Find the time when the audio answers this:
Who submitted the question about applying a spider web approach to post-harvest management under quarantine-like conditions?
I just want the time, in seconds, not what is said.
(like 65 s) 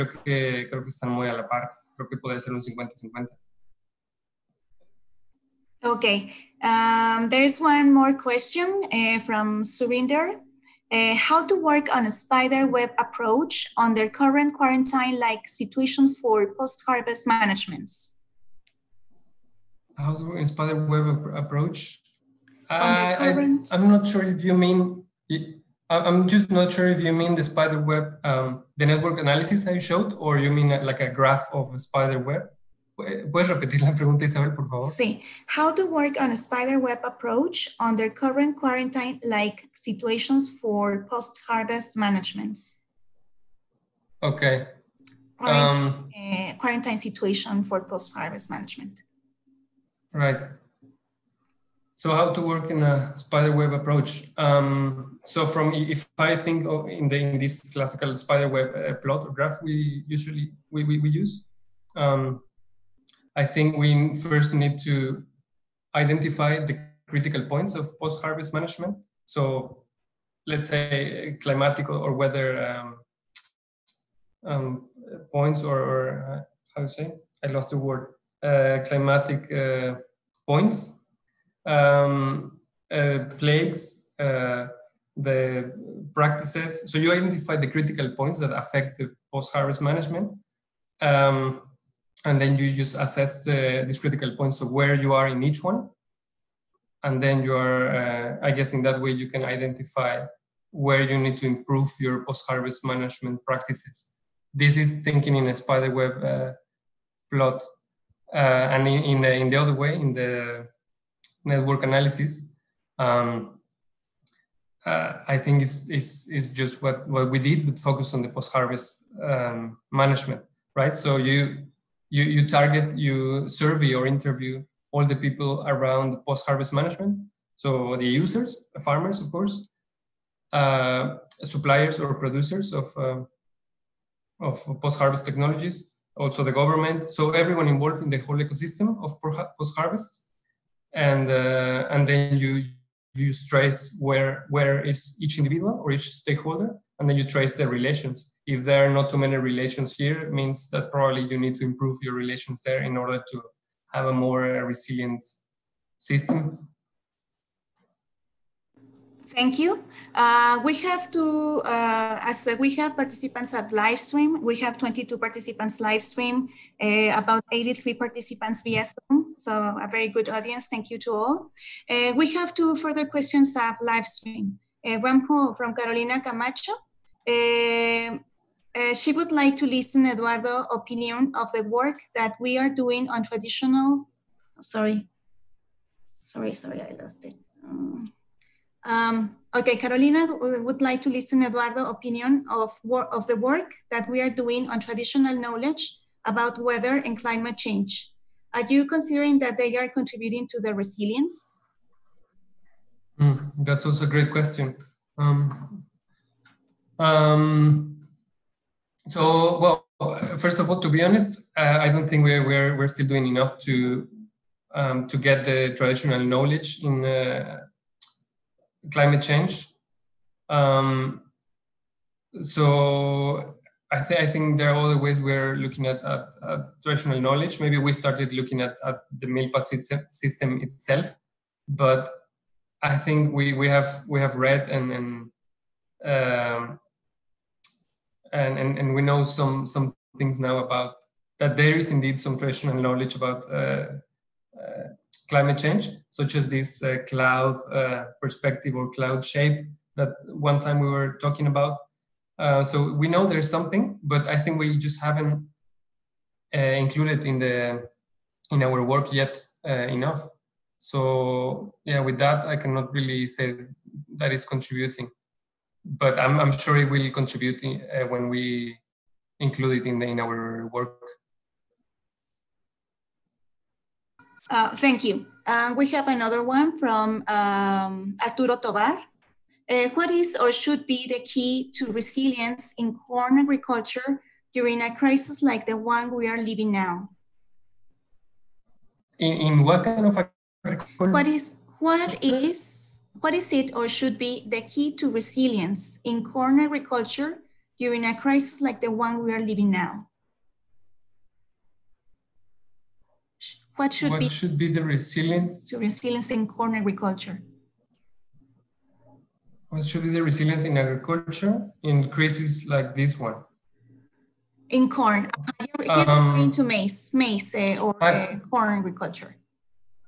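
9 s.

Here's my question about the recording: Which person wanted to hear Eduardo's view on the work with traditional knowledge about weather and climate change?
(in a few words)
Carolina Camacho.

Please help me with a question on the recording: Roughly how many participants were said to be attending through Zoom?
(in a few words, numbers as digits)
83.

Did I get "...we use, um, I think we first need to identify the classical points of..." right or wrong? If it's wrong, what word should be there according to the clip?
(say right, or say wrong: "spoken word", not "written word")
wrong: "critical", not "classical".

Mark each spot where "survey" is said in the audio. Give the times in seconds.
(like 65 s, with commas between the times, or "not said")
123 s.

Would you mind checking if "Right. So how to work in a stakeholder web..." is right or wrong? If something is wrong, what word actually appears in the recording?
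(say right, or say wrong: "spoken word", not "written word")
wrong: "spider", not "stakeholder".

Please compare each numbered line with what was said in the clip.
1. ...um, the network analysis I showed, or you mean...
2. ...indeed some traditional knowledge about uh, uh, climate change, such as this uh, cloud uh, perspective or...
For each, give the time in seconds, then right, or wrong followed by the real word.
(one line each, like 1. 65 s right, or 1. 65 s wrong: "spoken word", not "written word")
1. 28 s right
2. 241 s right.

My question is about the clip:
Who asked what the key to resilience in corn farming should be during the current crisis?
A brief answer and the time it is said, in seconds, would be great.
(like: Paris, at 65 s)
Arturo Tovar, at 278 s.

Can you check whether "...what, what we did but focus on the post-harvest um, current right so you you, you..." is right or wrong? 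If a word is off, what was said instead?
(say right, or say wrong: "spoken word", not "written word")
wrong: "management", not "current".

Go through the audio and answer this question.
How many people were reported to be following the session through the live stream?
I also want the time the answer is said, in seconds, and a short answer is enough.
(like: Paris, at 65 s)
22, at 164 s.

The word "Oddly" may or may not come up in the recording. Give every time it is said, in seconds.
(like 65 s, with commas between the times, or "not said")
not said.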